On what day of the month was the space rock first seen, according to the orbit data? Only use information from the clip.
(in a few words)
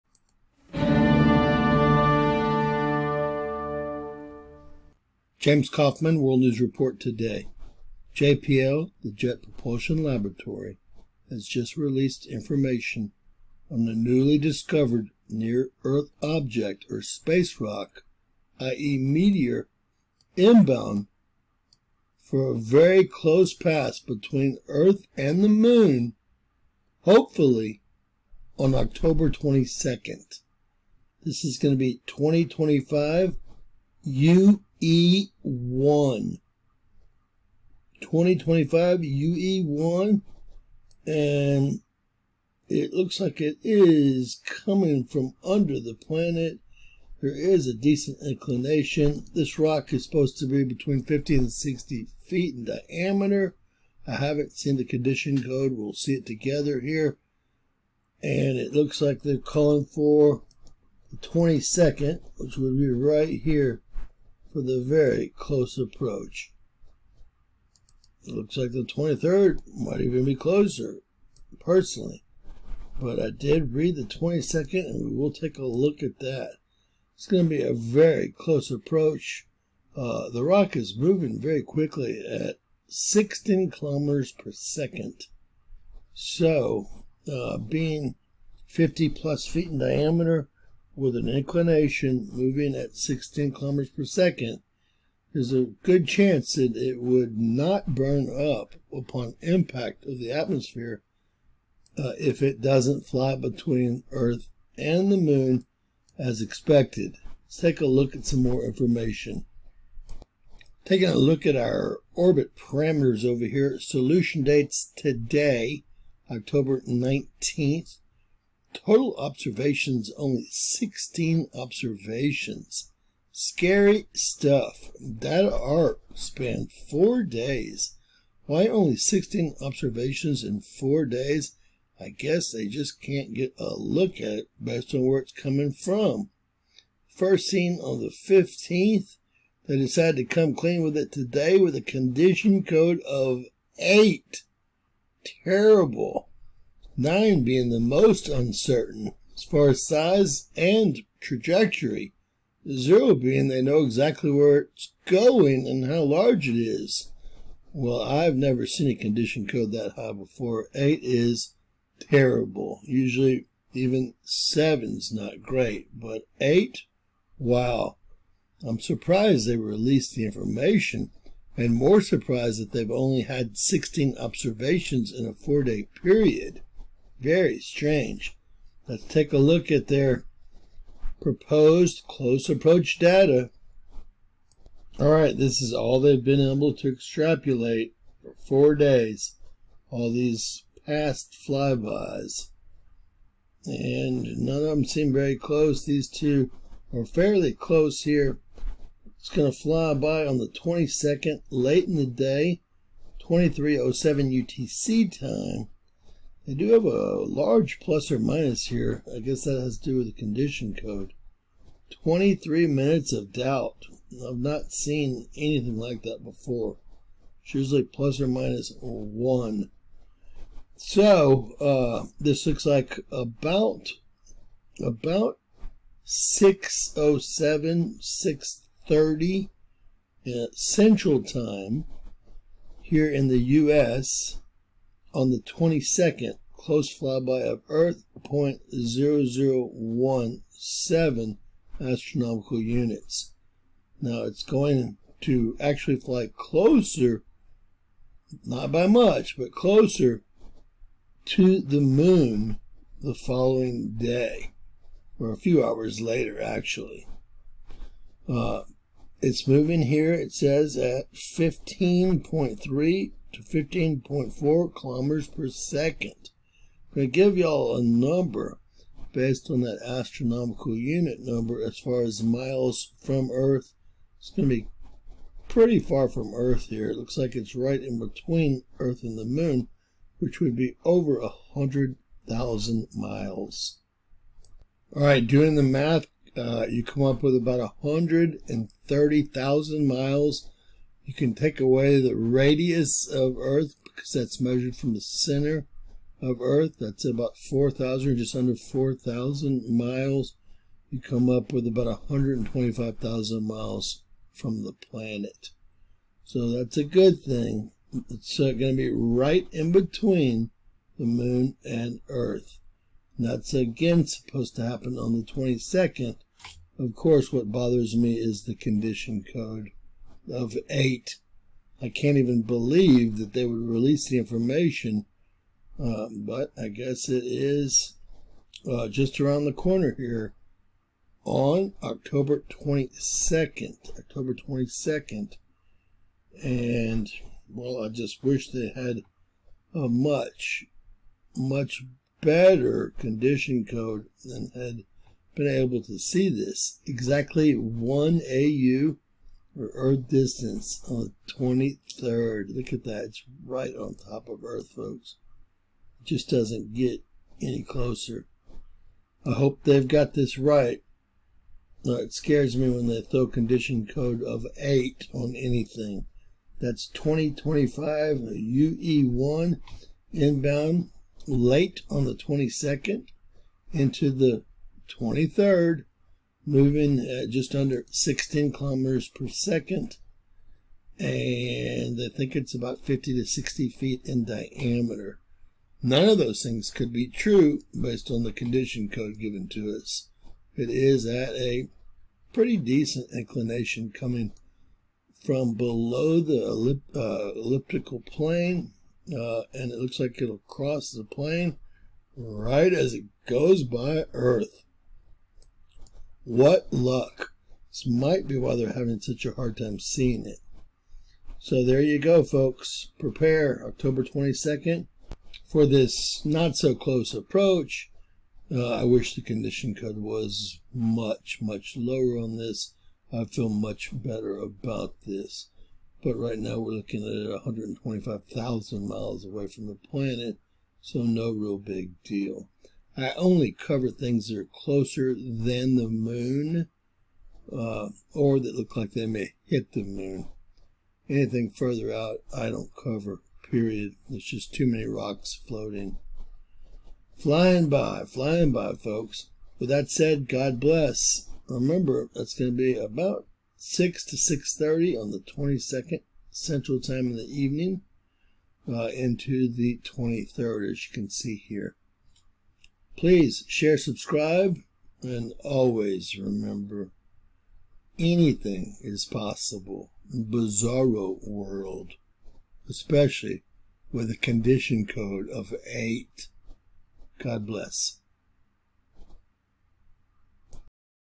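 15th.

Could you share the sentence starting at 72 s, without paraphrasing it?
But I did read the 22nd, and we will take a look at that.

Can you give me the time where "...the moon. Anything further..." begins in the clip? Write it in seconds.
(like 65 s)
439 s.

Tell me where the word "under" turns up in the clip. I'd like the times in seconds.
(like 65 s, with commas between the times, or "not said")
45 s, 298 s, 377 s.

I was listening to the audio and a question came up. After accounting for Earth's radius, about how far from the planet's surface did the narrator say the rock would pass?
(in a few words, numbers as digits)
125,000 miles.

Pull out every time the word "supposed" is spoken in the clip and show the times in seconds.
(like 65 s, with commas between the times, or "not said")
50 s, 314 s.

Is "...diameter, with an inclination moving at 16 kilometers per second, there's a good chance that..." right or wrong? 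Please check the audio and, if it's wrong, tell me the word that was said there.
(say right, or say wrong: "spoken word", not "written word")
right.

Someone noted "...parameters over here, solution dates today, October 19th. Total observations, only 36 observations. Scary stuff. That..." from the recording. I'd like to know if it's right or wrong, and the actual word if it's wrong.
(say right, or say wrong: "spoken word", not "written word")
wrong: "16", not "36".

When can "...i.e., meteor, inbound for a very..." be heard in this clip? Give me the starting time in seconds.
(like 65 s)
18 s.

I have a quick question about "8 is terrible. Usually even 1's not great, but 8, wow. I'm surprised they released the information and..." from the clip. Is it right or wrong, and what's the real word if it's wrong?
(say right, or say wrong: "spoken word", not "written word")
wrong: "7", not "1".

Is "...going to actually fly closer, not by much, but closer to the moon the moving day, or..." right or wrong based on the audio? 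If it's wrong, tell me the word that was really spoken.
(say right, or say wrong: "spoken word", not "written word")
wrong: "following", not "moving".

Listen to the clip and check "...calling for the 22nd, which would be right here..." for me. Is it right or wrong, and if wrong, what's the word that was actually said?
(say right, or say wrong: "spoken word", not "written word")
right.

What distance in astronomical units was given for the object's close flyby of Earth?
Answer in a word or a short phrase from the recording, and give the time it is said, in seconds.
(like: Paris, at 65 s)
0.0017, at 238 s.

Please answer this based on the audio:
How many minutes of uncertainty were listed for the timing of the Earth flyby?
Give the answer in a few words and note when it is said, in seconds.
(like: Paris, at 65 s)
23 minutes, at 212 s.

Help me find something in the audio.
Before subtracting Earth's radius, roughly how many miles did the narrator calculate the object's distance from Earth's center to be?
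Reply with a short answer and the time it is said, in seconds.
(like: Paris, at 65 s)
130,000 miles, at 287 s.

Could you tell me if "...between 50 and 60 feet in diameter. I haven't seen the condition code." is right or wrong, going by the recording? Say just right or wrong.
right.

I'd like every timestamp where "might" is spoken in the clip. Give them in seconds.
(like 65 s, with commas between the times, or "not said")
69 s, 407 s.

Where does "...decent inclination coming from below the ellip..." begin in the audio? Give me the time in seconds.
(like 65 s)
392 s.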